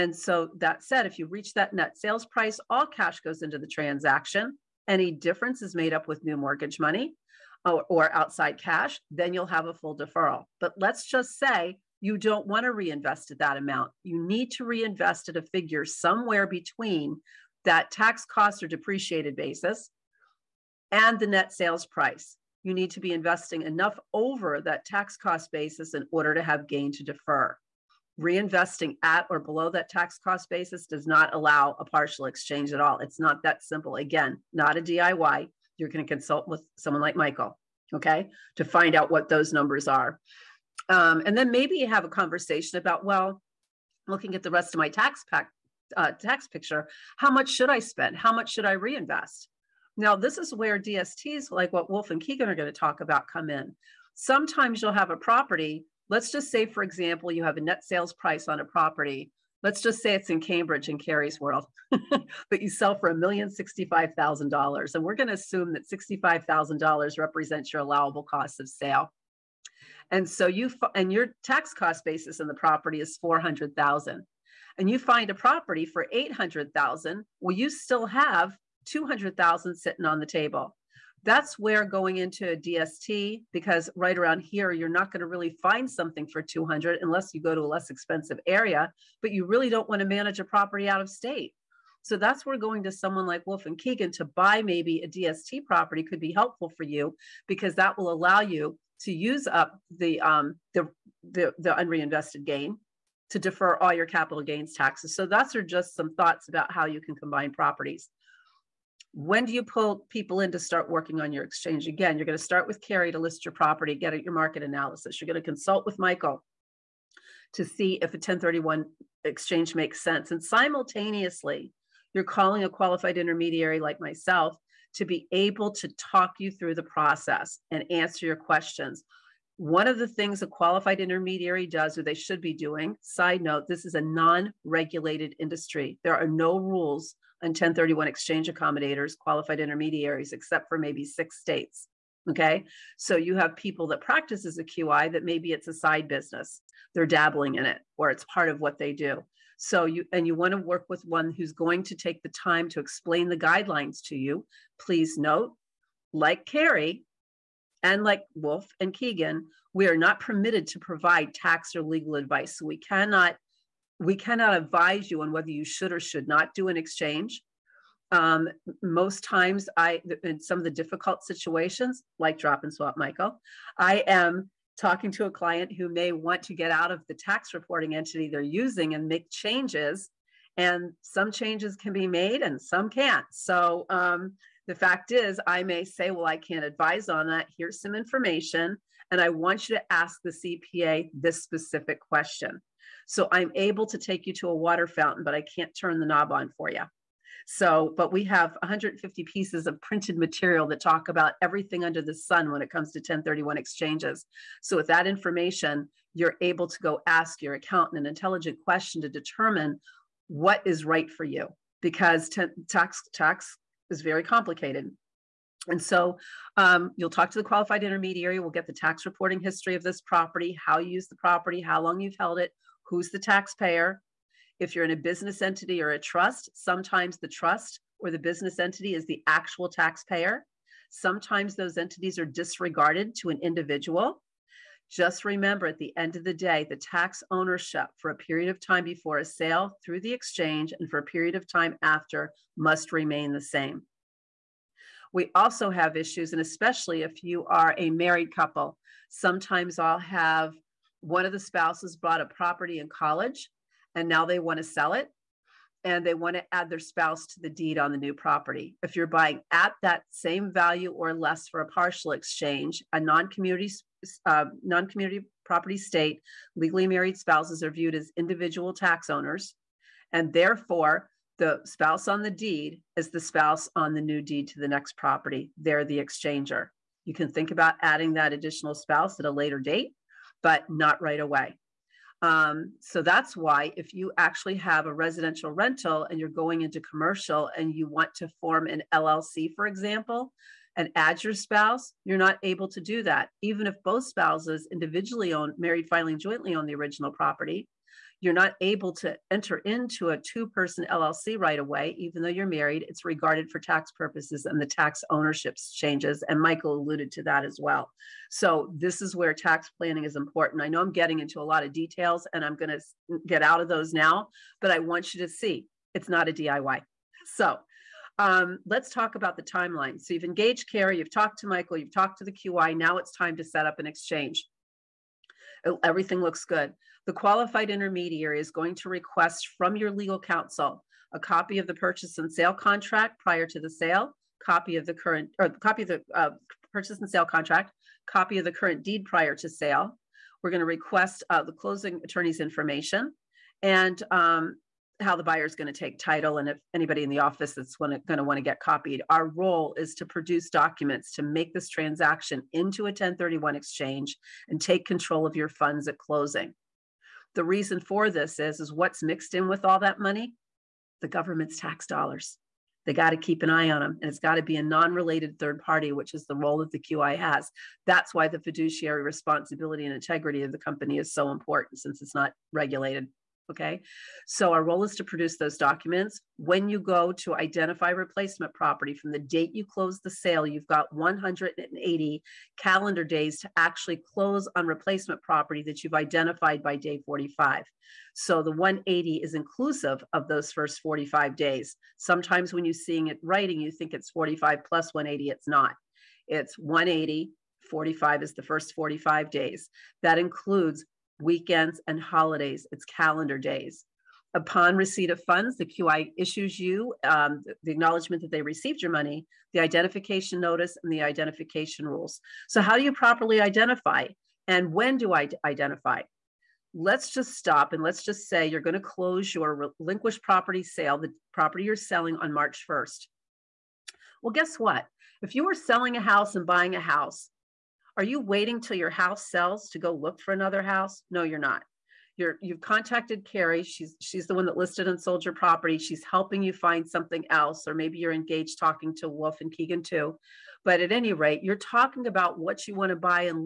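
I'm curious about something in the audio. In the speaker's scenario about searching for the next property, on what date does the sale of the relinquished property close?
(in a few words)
March 1st.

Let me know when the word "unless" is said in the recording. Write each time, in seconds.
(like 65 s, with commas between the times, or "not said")
87 s.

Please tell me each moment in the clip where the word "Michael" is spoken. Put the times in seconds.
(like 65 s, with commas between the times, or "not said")
37 s, 115 s, 172 s, 306 s, 321 s.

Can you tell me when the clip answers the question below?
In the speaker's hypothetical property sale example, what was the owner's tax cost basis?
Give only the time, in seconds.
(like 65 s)
73 s.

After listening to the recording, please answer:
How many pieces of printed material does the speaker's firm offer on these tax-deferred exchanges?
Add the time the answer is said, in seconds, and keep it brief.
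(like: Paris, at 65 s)
150, at 198 s.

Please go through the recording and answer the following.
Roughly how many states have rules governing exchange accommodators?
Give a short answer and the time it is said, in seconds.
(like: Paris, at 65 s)
6, at 141 s.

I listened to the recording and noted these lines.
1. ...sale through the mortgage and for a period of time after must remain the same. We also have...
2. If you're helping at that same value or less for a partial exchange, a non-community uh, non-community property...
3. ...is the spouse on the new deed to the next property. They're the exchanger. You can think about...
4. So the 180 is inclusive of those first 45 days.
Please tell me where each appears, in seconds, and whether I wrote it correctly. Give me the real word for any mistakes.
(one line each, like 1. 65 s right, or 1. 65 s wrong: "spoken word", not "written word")
1. 239 s wrong: "exchange", not "mortgage"
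2. 258 s wrong: "buying", not "helping"
3. 272 s right
4. 388 s right.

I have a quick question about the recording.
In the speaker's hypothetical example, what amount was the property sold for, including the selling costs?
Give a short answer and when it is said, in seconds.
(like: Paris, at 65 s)
$1,065,000, at 63 s.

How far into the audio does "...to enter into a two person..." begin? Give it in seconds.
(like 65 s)
298 s.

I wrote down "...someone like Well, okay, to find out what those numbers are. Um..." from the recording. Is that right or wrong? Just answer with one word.
wrong.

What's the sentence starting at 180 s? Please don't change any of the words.
And some changes can be made and some can't.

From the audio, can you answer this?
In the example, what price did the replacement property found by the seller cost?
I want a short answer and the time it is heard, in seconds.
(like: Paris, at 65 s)
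$800,000, at 76 s.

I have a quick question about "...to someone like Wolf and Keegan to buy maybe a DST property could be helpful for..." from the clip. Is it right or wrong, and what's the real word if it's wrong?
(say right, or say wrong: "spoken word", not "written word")
right.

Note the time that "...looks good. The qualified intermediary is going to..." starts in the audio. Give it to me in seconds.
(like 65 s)
326 s.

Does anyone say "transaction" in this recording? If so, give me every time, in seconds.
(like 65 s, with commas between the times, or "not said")
3 s, 351 s.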